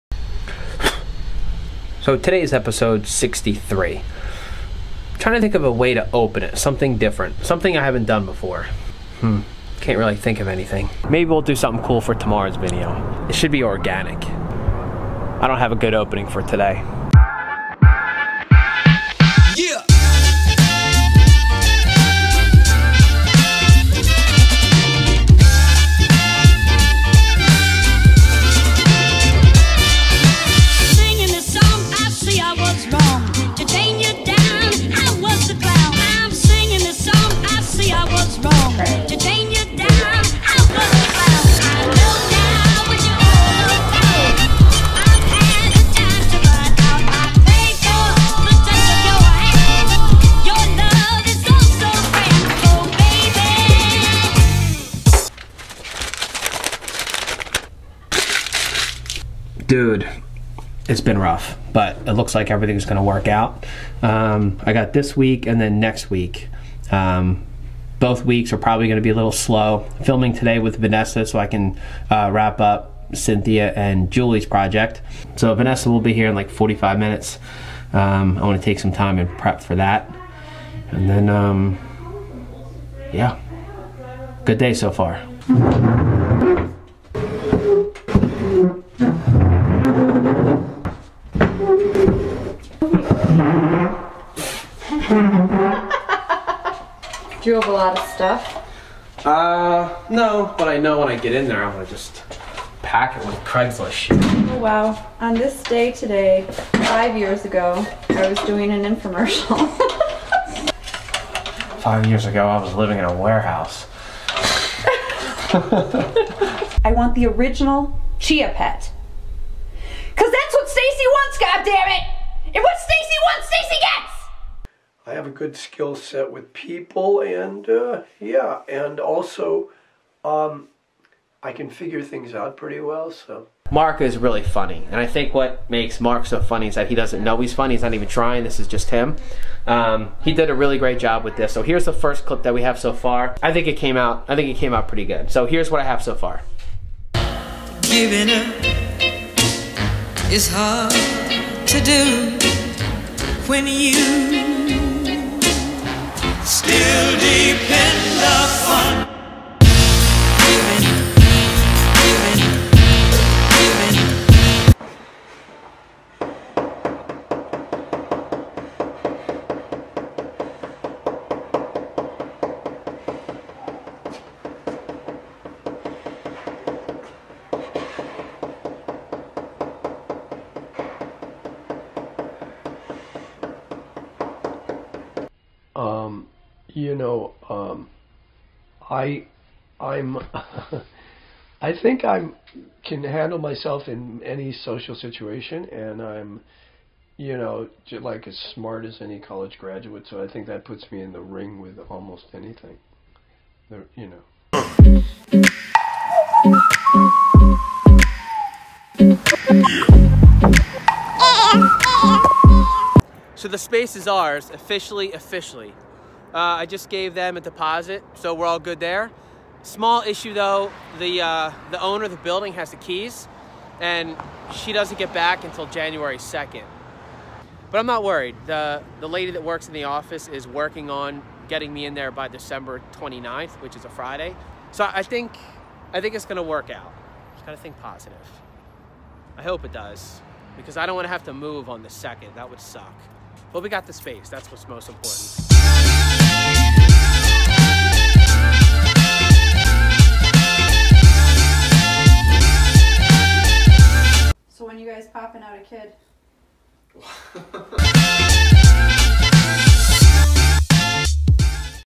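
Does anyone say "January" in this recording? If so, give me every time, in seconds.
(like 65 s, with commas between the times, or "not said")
225 s.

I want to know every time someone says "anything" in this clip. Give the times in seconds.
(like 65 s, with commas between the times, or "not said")
10 s, 202 s.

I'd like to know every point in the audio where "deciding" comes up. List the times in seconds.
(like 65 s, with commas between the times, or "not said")
not said.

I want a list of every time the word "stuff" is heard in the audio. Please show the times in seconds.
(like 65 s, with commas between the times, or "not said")
98 s.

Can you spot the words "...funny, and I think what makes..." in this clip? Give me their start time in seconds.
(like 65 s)
134 s.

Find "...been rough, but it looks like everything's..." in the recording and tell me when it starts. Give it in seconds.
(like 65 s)
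60 s.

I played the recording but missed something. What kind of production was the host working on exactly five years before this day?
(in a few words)
infomercial.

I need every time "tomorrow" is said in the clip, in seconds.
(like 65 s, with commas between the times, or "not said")
12 s.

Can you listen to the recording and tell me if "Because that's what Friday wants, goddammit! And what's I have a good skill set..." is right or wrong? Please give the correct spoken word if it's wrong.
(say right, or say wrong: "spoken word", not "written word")
wrong: "Stacy", not "Friday".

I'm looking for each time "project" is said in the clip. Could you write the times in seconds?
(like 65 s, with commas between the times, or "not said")
74 s.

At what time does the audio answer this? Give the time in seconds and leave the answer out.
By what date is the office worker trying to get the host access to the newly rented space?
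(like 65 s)
232 s.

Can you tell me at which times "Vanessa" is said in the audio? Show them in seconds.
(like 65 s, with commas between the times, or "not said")
70 s, 75 s.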